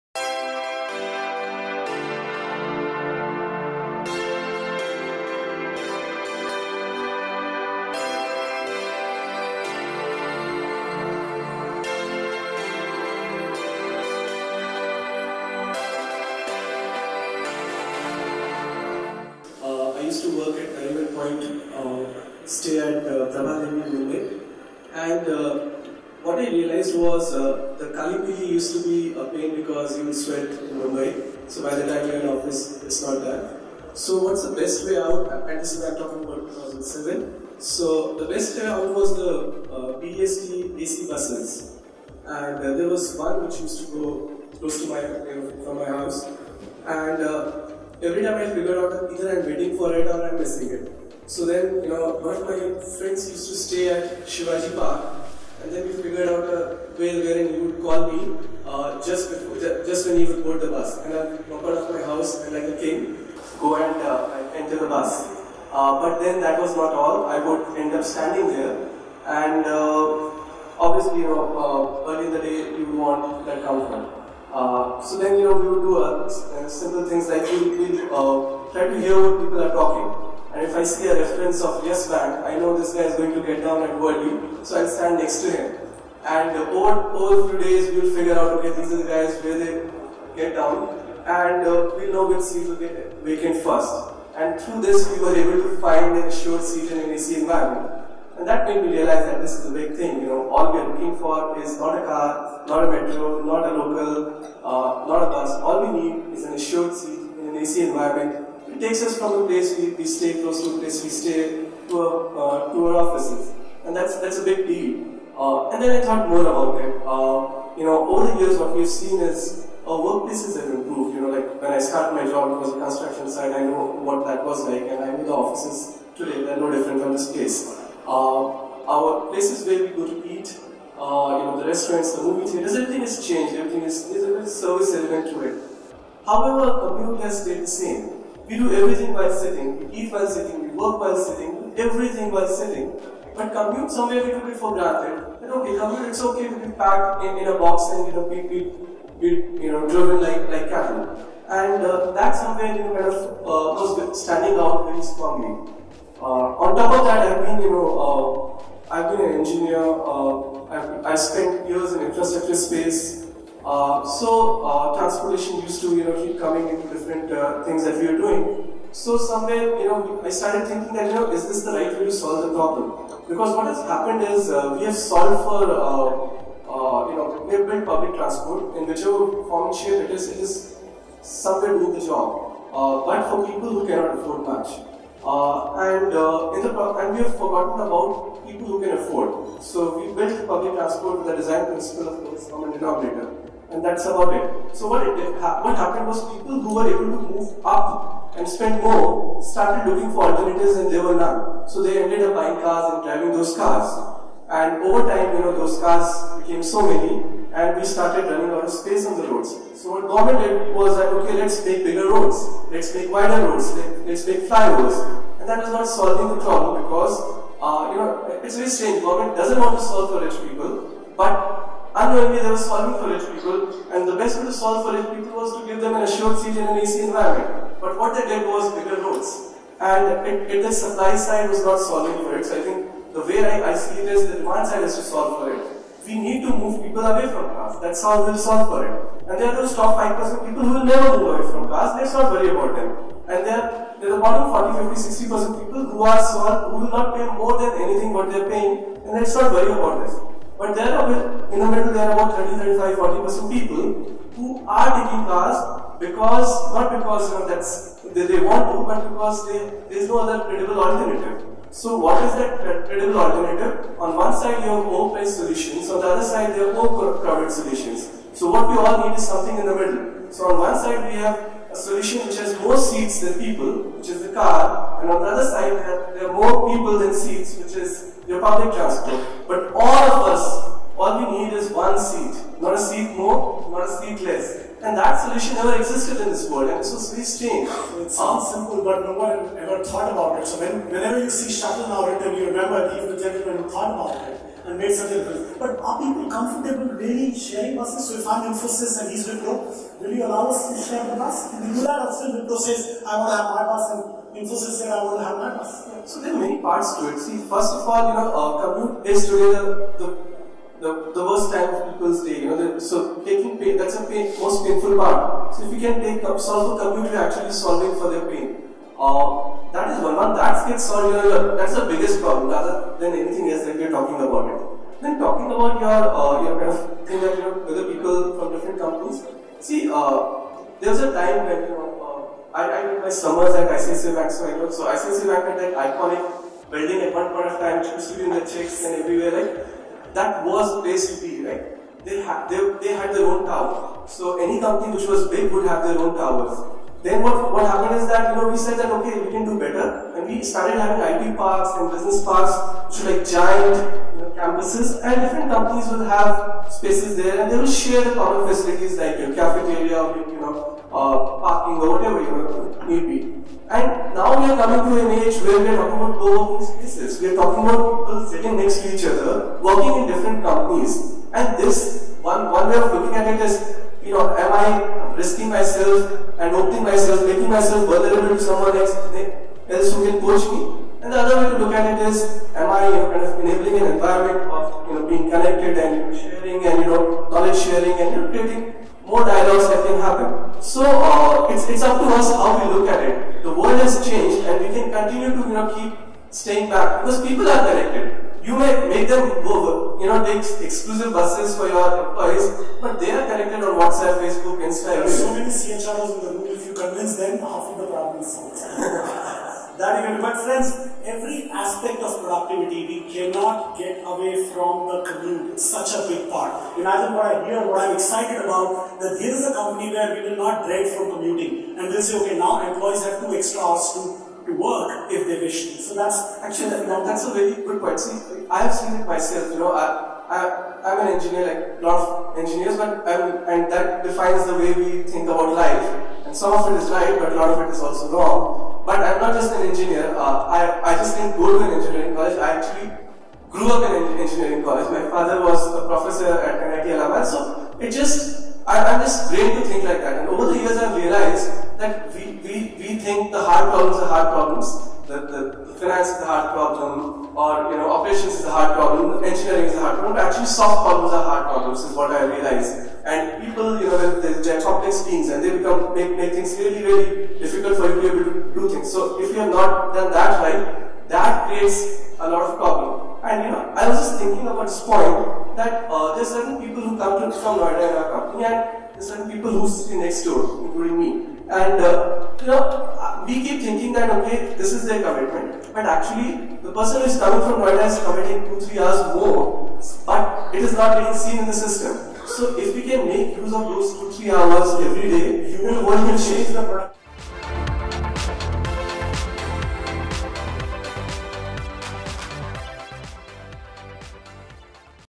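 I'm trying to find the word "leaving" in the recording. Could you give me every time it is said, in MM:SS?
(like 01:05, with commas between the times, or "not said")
not said.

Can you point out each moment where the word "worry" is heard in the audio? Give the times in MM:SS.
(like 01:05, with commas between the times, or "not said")
04:02, 04:09.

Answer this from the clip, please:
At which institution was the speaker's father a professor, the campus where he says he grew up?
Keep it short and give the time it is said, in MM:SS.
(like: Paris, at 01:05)
NIT Allahabad, at 07:26.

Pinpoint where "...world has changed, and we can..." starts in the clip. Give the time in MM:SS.
06:33.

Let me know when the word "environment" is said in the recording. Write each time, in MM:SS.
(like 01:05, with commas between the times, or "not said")
01:37, 01:47, 03:47, 06:23.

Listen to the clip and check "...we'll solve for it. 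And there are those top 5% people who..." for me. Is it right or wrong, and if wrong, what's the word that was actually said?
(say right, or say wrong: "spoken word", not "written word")
right.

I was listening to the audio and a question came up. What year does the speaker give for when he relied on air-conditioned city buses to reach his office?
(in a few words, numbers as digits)
2007.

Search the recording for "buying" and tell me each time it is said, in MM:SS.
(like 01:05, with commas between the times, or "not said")
03:22.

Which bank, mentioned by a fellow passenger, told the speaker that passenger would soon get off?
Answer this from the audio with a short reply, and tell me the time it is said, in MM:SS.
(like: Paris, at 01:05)
Yes Bank, at 01:21.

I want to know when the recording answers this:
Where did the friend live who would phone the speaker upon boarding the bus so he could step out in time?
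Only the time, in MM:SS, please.
00:54.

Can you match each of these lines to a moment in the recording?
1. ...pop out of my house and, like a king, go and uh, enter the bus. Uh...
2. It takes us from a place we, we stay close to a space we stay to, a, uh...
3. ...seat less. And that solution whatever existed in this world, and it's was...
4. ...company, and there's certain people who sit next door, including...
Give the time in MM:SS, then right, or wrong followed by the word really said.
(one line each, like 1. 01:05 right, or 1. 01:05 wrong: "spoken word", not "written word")
1. 01:01 right
2. 01:48 wrong: "place", not "space"
3. 04:43 wrong: "never", not "whatever"
4. 07:58 right.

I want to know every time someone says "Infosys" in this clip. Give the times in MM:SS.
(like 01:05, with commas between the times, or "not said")
04:58, 05:04.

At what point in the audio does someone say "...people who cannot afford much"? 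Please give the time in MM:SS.
03:03.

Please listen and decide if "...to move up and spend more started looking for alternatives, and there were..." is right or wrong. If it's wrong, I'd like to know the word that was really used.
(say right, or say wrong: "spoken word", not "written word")
right.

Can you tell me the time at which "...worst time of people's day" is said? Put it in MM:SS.
05:11.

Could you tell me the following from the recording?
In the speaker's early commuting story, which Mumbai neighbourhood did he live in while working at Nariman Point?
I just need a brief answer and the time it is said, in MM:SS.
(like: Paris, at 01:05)
Prabhadevi, at 00:23.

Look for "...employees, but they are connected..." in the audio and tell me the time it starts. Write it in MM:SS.
06:42.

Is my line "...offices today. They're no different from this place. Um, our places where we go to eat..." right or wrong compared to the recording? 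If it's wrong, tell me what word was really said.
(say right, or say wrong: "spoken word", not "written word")
right.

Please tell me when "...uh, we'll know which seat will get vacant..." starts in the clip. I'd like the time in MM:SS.
01:31.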